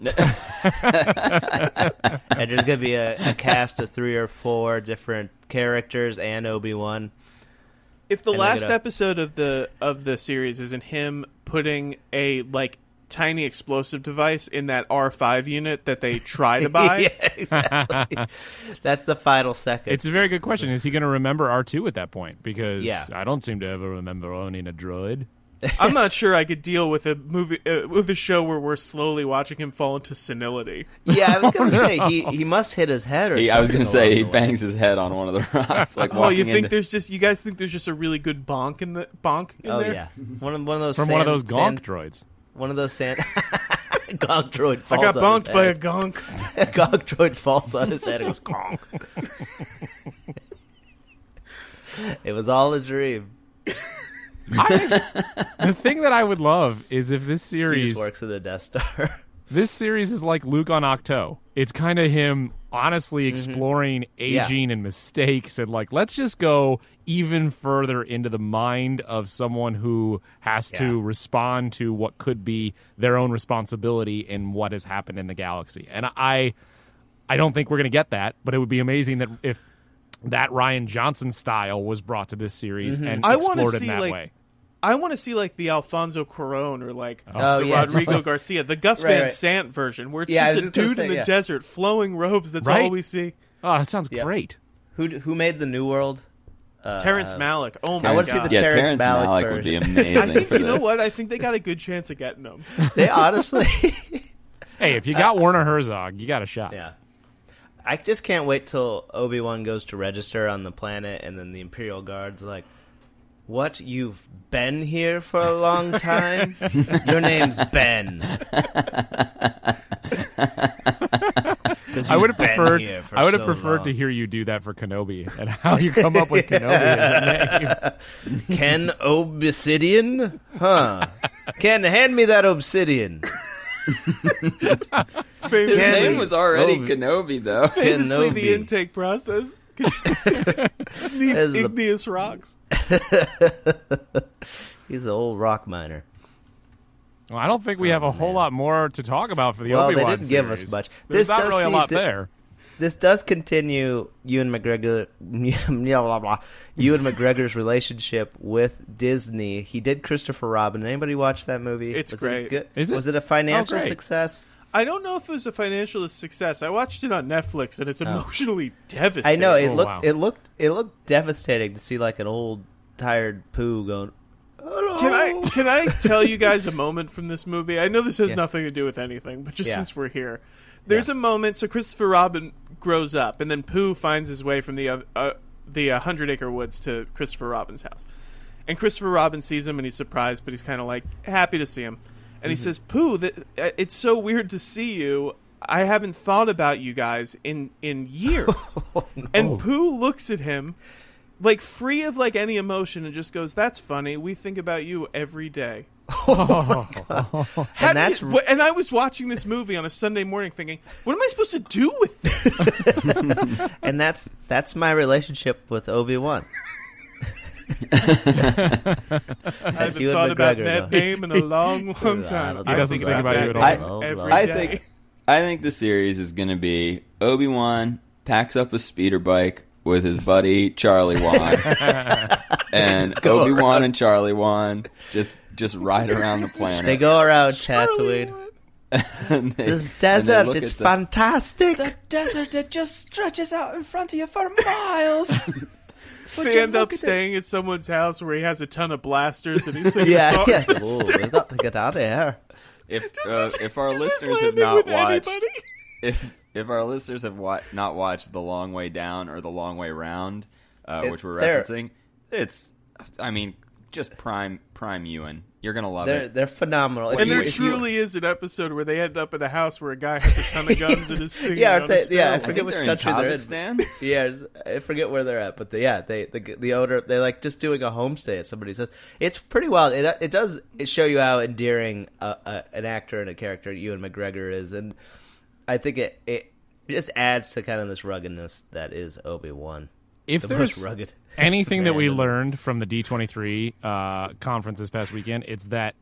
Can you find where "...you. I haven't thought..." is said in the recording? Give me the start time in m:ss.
3:14.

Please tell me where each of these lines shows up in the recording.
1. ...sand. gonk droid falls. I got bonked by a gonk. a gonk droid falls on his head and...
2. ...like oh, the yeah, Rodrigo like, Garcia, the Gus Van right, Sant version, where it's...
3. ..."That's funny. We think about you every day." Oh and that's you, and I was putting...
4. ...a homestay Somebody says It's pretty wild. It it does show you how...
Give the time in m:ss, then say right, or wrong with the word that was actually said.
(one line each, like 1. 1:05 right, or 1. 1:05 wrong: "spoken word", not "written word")
1. 0:42 right
2. 1:26 right
3. 3:23 wrong: "watching", not "putting"
4. 4:37 right.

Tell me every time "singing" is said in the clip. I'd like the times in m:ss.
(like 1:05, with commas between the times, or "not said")
4:09, 4:31.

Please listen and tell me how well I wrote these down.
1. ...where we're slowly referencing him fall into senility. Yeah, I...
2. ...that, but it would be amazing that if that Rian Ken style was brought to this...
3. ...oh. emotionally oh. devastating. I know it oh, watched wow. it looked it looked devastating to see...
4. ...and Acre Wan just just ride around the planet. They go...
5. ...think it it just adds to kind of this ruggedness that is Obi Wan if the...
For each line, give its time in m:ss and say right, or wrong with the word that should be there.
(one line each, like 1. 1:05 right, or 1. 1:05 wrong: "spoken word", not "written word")
1. 0:28 wrong: "watching", not "referencing"
2. 1:18 wrong: "Johnson", not "Ken"
3. 2:48 wrong: "looked", not "watched"
4. 3:53 wrong: "Charlie", not "Acre"
5. 4:45 right.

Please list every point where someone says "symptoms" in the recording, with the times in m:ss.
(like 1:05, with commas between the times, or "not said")
not said.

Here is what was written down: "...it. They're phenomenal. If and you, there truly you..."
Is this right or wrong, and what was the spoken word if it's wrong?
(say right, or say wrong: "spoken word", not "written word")
right.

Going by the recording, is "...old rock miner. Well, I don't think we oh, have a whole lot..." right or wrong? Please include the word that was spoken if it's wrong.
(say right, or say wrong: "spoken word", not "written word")
right.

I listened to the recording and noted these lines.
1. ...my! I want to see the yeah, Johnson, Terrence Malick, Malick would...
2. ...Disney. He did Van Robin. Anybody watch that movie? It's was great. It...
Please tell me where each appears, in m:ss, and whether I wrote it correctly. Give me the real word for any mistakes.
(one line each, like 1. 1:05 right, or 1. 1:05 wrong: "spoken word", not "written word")
1. 1:37 wrong: "Terrence", not "Johnson"
2. 2:38 wrong: "Christopher", not "Van".